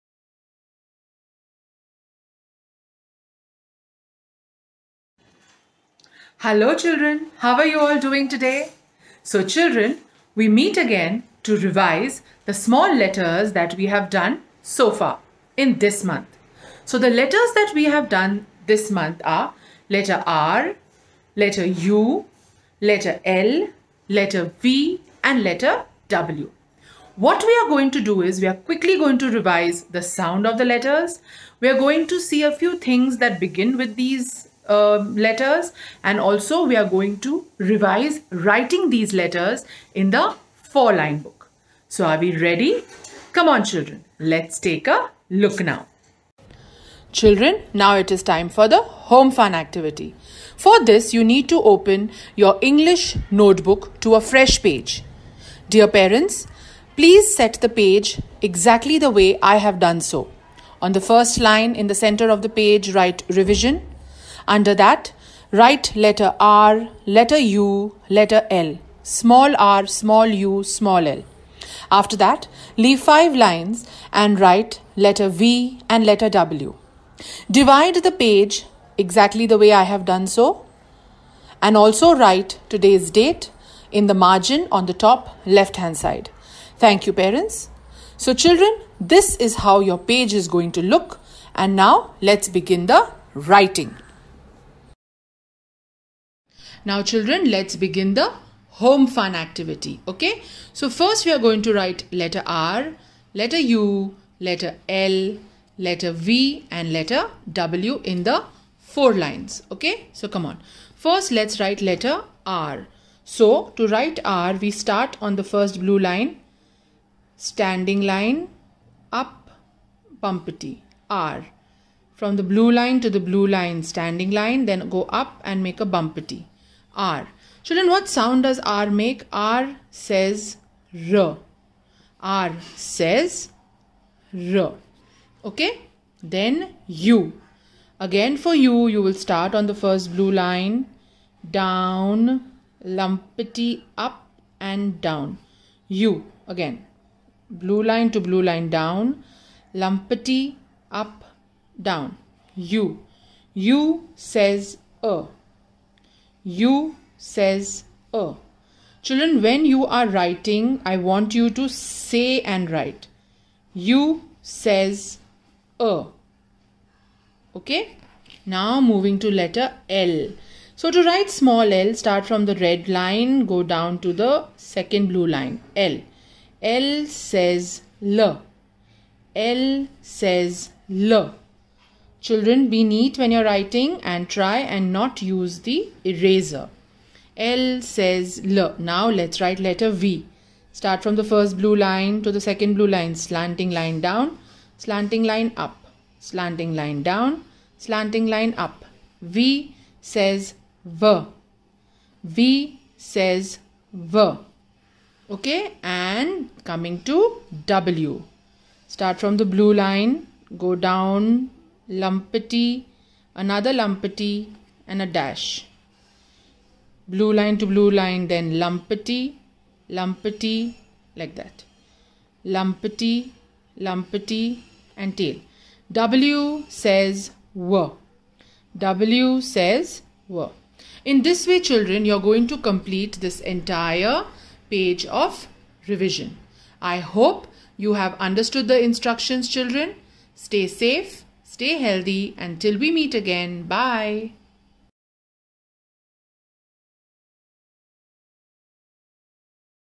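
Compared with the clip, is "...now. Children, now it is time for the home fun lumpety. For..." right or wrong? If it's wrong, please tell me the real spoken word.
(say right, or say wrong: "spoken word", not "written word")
wrong: "activity", not "lumpety".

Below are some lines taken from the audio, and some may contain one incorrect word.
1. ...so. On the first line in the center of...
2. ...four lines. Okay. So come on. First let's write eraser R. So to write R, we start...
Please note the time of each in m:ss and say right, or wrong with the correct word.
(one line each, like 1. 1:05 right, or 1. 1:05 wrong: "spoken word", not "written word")
1. 0:59 right
2. 1:48 wrong: "letter", not "eraser".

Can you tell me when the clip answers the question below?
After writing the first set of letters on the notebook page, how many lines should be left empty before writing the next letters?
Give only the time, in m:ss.
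1:12.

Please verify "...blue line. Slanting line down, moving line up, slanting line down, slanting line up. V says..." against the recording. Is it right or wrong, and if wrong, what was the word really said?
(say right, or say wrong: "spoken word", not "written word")
wrong: "slanting", not "moving".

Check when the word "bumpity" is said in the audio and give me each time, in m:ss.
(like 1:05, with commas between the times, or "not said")
2:00, 2:05.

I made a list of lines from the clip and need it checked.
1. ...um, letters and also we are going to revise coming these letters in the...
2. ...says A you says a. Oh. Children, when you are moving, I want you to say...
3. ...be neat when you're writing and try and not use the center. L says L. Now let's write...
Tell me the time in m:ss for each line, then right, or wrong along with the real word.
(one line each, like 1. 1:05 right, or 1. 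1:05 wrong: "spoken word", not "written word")
1. 0:34 wrong: "writing", not "coming"
2. 2:34 wrong: "writing", not "moving"
3. 3:02 wrong: "eraser", not "center".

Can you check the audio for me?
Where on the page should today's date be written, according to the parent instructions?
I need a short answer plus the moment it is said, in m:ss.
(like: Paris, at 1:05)
top left hand side, at 1:24.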